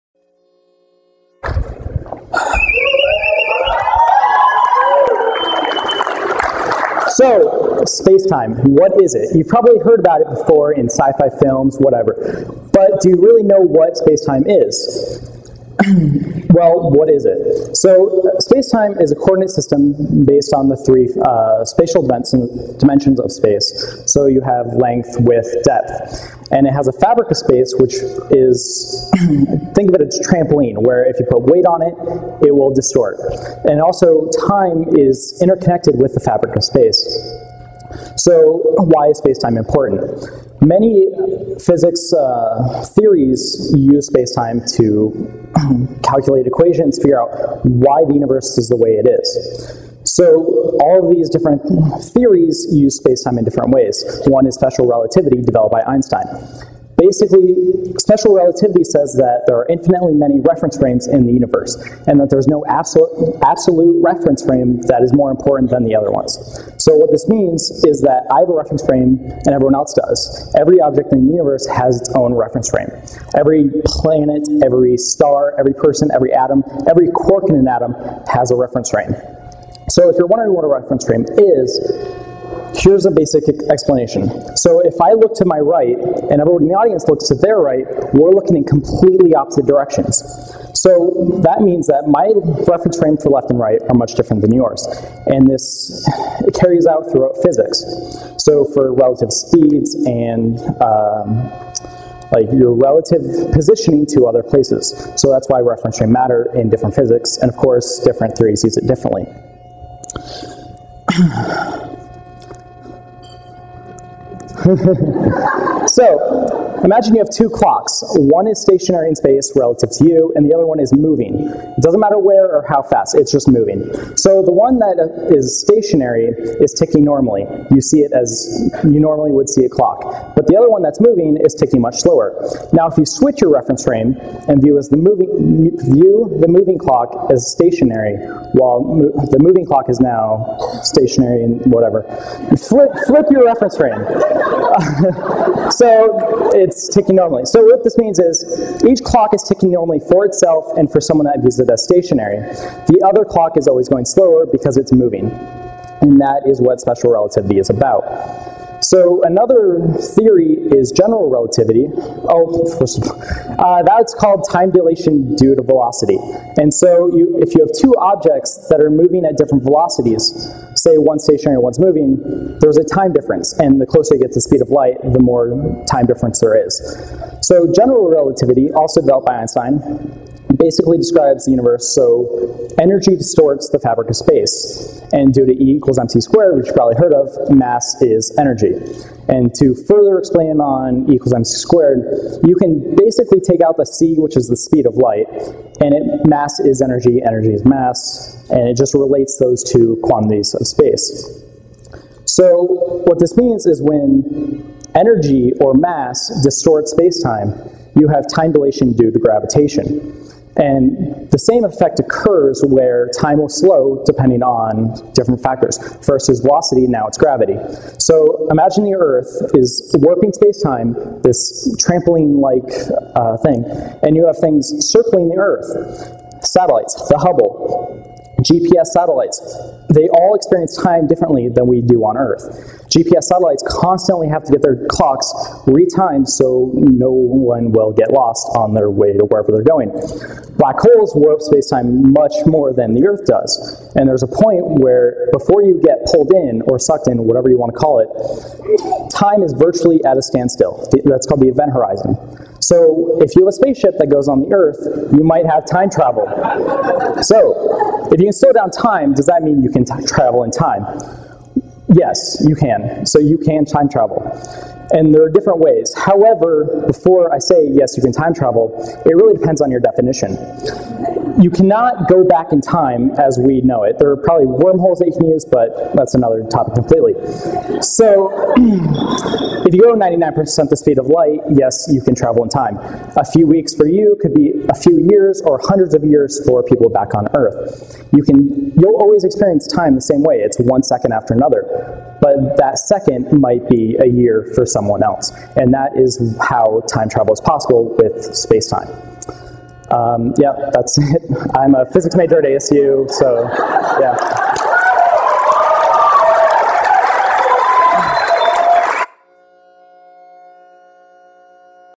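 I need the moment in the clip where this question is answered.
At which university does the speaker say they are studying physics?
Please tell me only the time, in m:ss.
5:02.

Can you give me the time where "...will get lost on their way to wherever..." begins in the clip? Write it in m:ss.
3:57.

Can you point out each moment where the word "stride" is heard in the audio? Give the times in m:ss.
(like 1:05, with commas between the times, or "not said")
not said.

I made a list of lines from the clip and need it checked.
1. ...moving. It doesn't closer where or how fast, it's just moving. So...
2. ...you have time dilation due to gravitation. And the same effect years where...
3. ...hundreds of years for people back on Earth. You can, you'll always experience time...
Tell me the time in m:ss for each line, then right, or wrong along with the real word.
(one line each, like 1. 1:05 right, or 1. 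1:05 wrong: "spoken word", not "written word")
1. 2:00 wrong: "matter", not "closer"
2. 3:27 wrong: "occurs", not "years"
3. 4:45 right.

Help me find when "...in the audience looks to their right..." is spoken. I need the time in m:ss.
1:26.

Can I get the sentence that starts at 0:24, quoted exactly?
So, you have length, width, depth.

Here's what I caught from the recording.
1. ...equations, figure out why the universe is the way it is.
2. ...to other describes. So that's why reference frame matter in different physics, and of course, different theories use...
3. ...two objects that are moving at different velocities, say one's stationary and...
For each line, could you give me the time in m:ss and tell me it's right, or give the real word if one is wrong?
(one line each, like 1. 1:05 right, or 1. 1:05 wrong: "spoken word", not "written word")
1. 0:46 right
2. 1:44 wrong: "places", not "describes"
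3. 2:47 right.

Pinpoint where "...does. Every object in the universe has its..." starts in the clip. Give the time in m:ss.
1:09.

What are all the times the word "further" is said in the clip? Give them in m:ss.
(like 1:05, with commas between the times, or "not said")
3:09.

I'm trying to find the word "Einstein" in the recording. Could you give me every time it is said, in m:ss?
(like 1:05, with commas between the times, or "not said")
0:55, 2:59.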